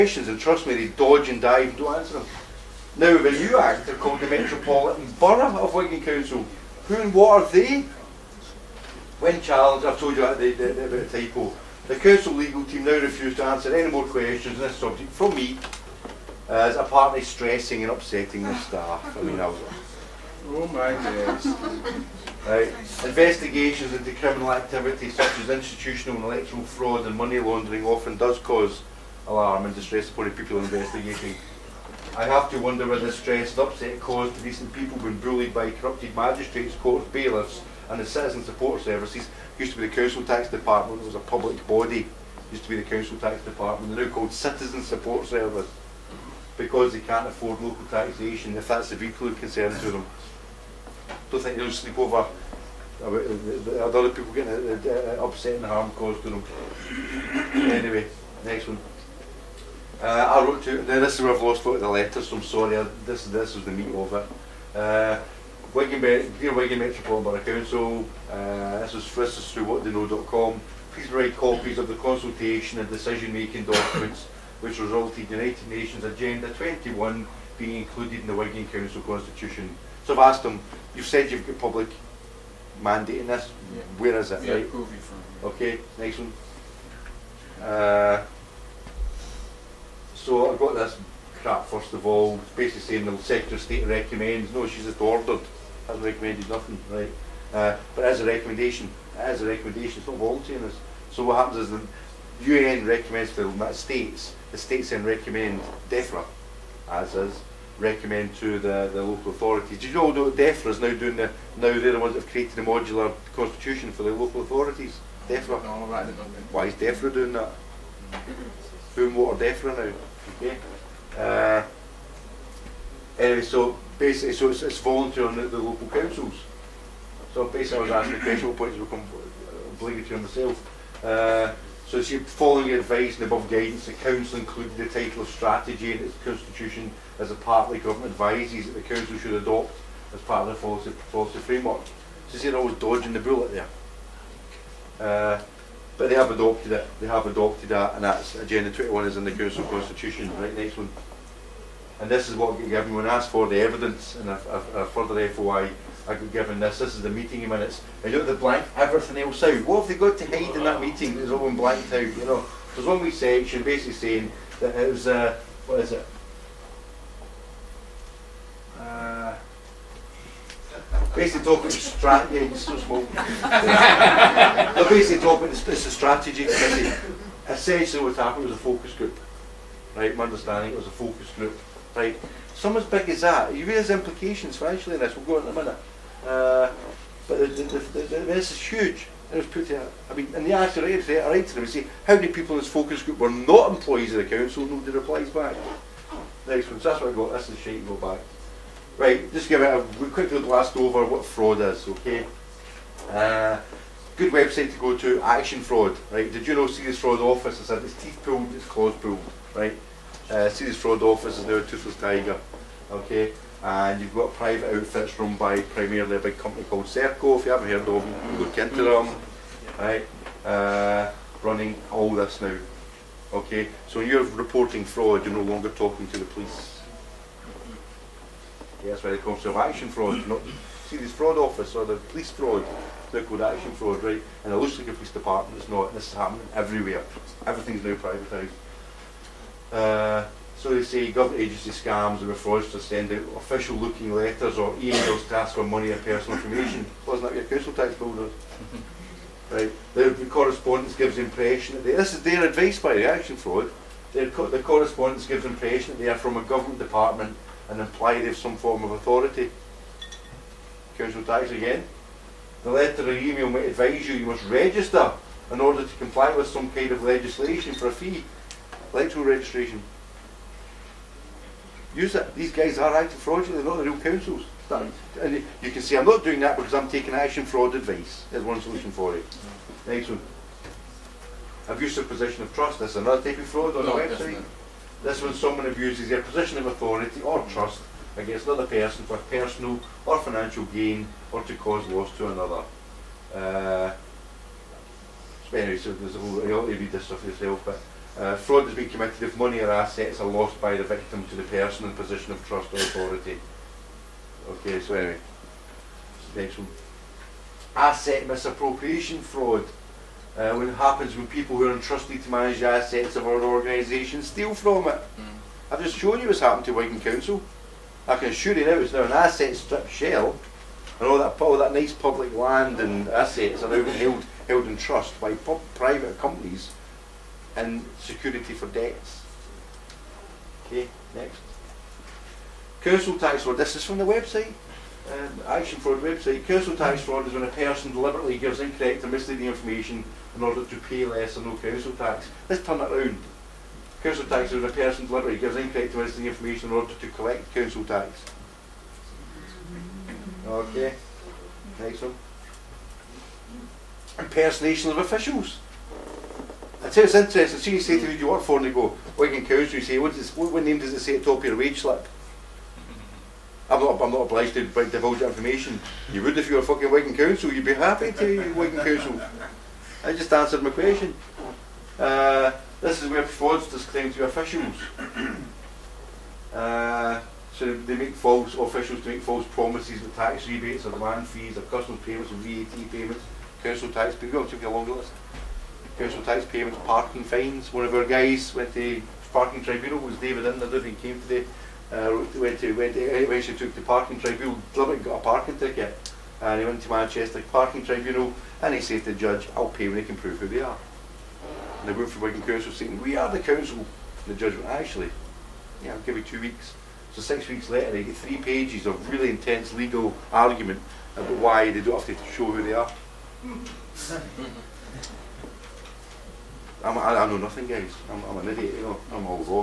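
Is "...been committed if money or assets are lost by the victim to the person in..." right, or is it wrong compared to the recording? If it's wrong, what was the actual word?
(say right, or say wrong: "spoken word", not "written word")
right.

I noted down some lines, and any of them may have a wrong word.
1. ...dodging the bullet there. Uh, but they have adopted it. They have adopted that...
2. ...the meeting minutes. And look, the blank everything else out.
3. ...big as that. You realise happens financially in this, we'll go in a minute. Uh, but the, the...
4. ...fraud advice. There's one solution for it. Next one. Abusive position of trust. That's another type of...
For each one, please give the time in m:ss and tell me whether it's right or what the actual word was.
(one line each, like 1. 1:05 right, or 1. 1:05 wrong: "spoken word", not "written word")
1. 2:22 right
2. 2:37 right
3. 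3:02 wrong: "implications", not "happens"
4. 4:37 right.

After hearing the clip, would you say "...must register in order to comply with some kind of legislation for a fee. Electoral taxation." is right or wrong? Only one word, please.
wrong.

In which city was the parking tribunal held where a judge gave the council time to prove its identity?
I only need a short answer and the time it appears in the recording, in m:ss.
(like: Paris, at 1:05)
Manchester, at 6:36.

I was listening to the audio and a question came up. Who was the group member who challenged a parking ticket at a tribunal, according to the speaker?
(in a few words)
David Inner.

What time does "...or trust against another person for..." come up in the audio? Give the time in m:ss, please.
4:47.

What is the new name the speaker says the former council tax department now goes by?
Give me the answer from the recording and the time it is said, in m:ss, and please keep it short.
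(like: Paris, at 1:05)
Citizen Support Service, at 0:44.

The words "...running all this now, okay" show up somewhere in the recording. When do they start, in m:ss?
3:41.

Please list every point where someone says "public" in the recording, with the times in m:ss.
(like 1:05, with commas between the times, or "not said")
0:41, 1:21, 5:21.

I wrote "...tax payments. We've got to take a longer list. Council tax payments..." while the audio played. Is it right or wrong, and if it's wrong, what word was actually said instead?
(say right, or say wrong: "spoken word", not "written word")
right.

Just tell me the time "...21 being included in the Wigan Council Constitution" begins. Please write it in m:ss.
1:16.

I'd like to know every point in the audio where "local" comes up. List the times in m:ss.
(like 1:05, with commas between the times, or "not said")
0:47, 1:49, 1:54, 2:05.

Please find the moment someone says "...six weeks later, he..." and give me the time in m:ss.
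6:47.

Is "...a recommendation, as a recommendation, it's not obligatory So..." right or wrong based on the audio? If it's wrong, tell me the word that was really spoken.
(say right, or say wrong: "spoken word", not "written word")
wrong: "voluntary", not "obligatory".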